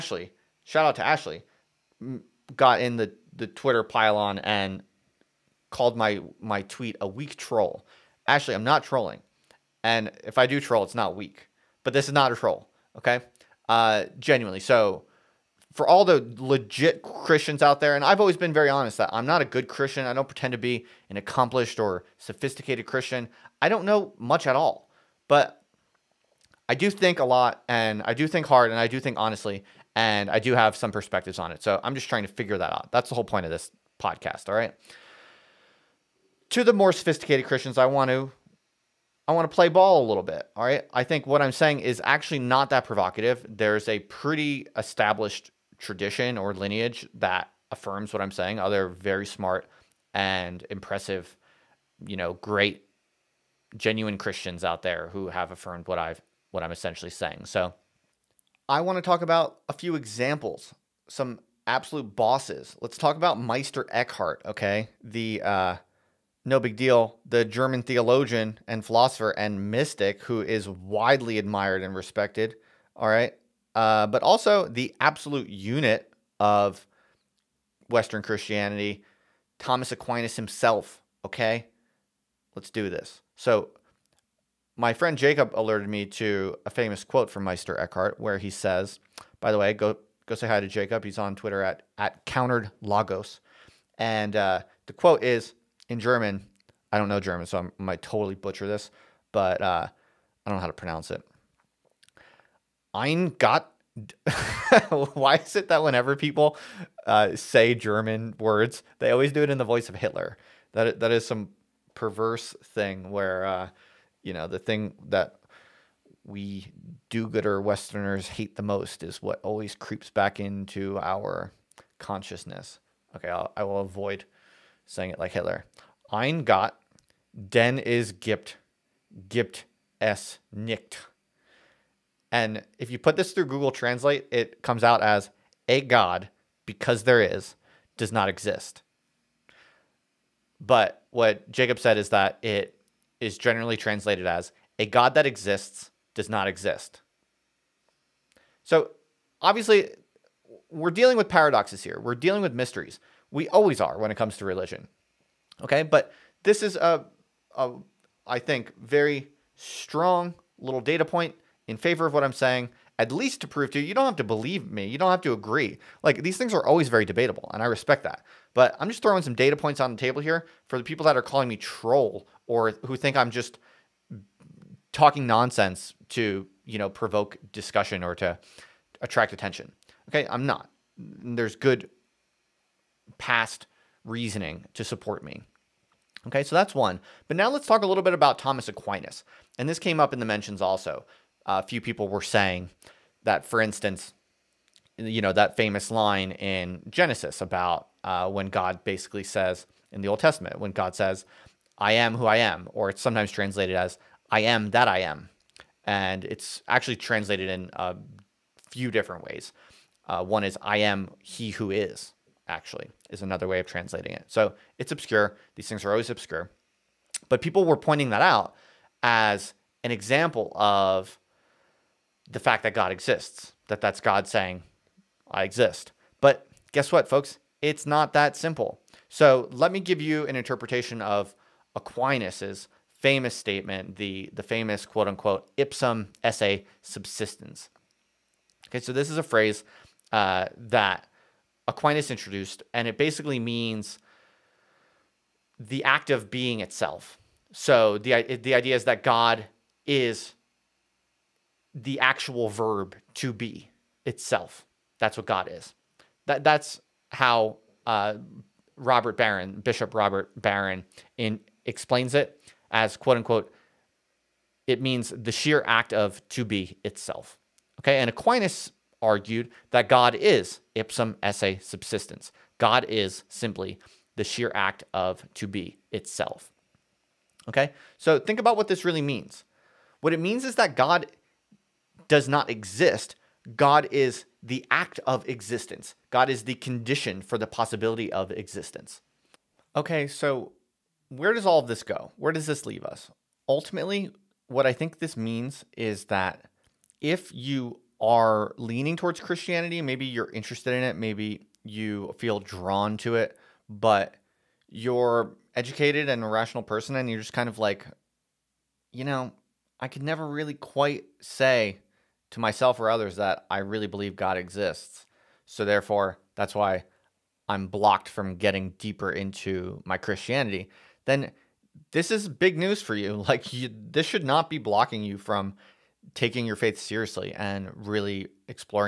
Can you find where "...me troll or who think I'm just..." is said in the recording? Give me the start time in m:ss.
2:51.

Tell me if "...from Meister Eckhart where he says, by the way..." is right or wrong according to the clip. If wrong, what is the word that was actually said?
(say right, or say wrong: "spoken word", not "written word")
right.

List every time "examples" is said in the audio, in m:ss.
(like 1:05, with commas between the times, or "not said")
0:59, 3:39.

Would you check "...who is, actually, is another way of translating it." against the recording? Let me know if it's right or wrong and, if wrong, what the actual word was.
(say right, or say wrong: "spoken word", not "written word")
right.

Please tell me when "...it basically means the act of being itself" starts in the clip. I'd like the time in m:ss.
4:02.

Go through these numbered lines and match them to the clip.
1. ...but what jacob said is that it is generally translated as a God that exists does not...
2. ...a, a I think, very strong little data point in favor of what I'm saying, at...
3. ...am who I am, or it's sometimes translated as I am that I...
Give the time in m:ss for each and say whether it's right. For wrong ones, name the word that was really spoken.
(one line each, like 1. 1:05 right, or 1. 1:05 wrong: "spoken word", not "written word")
1. 2:20 right
2. 2:36 right
3. 3:21 right.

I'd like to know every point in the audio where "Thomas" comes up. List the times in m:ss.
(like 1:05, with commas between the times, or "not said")
1:19, 3:08.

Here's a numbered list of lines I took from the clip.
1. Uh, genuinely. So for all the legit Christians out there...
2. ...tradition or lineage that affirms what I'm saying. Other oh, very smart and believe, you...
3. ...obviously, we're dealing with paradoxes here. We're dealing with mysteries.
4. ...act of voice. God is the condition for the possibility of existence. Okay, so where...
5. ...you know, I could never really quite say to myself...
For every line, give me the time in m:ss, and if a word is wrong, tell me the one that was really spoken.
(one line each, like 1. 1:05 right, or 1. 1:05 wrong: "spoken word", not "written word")
1. 0:13 right
2. 0:45 wrong: "impressive", not "believe"
3. 2:29 right
4. 4:44 wrong: "existence", not "voice"
5. 5:08 right.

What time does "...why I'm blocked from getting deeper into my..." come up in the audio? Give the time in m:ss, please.
5:16.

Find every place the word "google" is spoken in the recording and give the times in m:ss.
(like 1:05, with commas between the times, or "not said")
2:13.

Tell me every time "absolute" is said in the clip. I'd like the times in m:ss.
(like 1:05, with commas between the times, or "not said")
1:01, 1:14.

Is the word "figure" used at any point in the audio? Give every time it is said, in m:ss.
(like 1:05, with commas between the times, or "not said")
0:32.